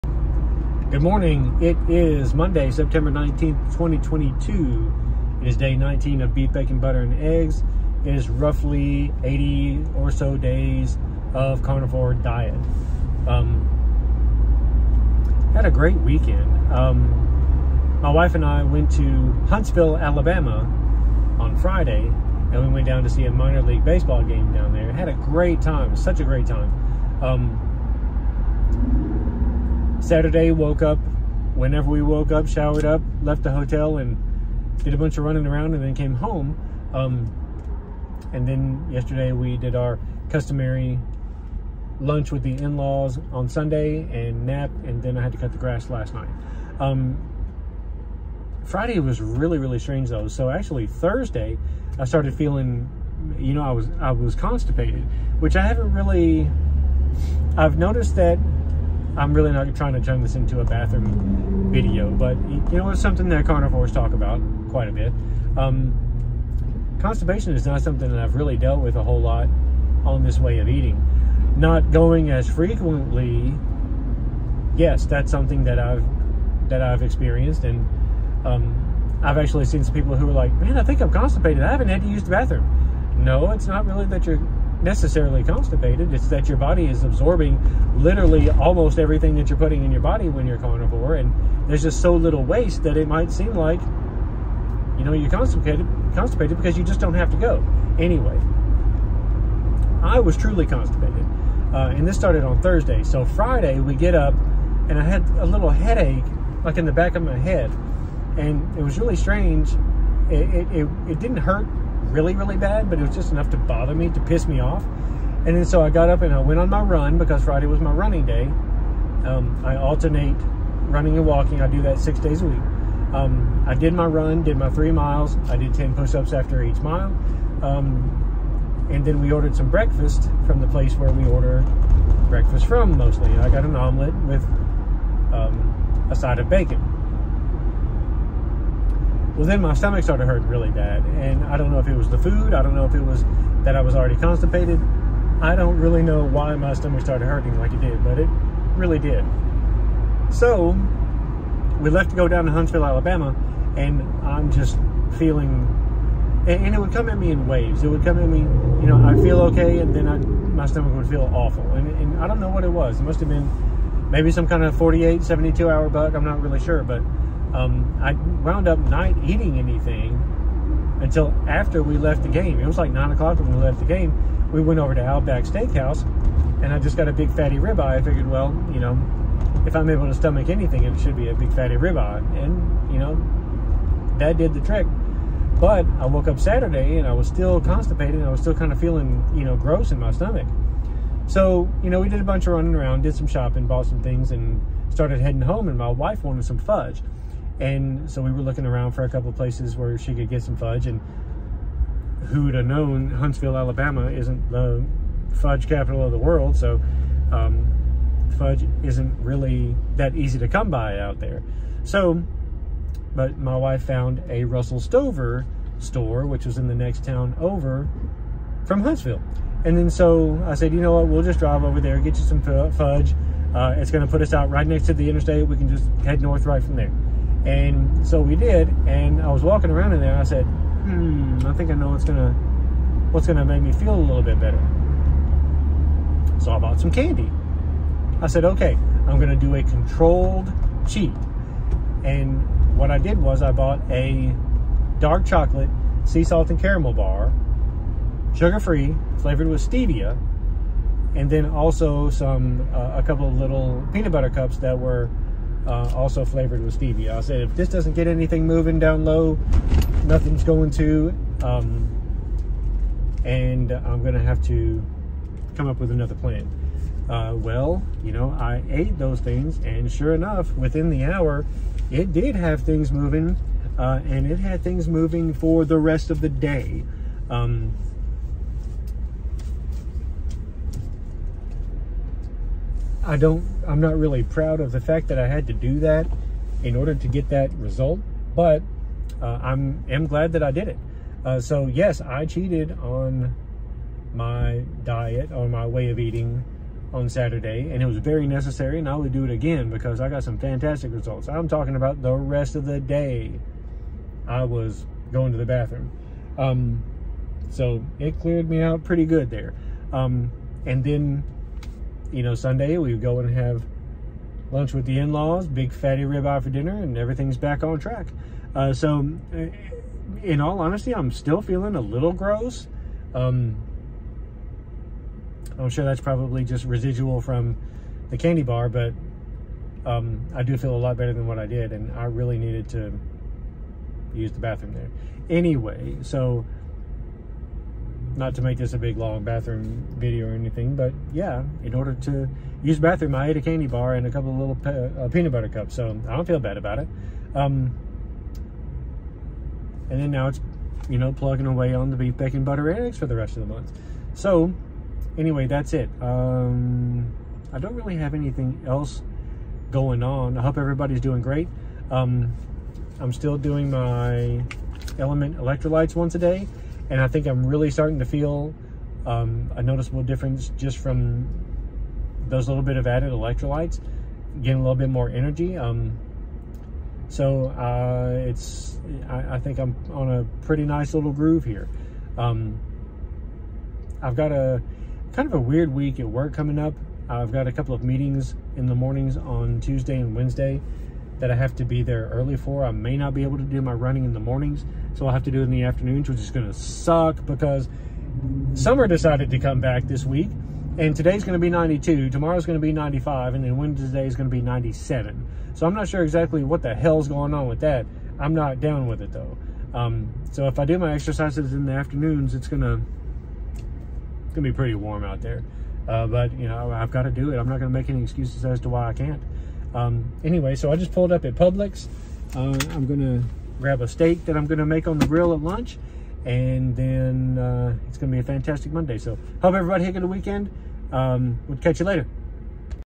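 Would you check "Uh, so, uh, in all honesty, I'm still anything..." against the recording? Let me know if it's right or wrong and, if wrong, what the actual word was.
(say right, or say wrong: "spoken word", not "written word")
wrong: "feeling", not "anything".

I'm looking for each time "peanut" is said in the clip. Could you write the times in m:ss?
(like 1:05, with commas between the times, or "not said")
4:13, 5:45.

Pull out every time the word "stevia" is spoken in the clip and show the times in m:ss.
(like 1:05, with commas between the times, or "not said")
4:09, 4:16.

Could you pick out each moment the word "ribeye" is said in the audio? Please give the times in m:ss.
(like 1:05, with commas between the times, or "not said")
2:57, 3:01, 5:16.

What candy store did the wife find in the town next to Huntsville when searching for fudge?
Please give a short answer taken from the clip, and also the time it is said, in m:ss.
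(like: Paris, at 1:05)
Russell Stover, at 3:34.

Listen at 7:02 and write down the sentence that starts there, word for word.
Uh, I'm gonna grab a steak that I'm gonna make on the grill at lunch.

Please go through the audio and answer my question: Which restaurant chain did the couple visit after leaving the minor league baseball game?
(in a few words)
Outback Steakhouse.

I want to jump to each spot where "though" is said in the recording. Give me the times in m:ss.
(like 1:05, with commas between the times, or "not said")
0:50, 6:49.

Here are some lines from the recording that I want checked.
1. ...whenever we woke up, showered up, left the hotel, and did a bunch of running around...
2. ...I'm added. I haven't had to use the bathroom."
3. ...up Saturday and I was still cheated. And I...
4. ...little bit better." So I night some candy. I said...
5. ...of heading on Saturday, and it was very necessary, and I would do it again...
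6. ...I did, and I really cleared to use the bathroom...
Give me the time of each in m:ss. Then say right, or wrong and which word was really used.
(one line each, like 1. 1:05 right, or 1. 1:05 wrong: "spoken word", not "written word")
1. 0:31 right
2. 1:21 wrong: "constipated", not "added"
3. 3:06 wrong: "constipated", not "cheated"
4. 3:53 wrong: "bought", not "night"
5. 4:55 wrong: "eating", not "heading"
6. 5:31 wrong: "needed", not "cleared".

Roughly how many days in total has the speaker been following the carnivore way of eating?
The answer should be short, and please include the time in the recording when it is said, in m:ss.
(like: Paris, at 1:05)
80, at 0:09.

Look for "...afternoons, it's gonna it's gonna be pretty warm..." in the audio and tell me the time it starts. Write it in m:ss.
6:51.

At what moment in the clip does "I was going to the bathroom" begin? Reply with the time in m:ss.
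5:04.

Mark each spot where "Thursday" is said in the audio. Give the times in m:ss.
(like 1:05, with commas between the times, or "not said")
0:50, 1:42.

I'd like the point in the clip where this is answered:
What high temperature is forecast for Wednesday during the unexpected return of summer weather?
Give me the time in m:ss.
6:44.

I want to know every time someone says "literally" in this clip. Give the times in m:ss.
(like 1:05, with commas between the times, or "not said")
1:28.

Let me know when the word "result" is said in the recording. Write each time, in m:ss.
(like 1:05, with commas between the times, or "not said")
4:47, 5:00.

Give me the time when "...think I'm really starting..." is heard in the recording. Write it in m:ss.
6:07.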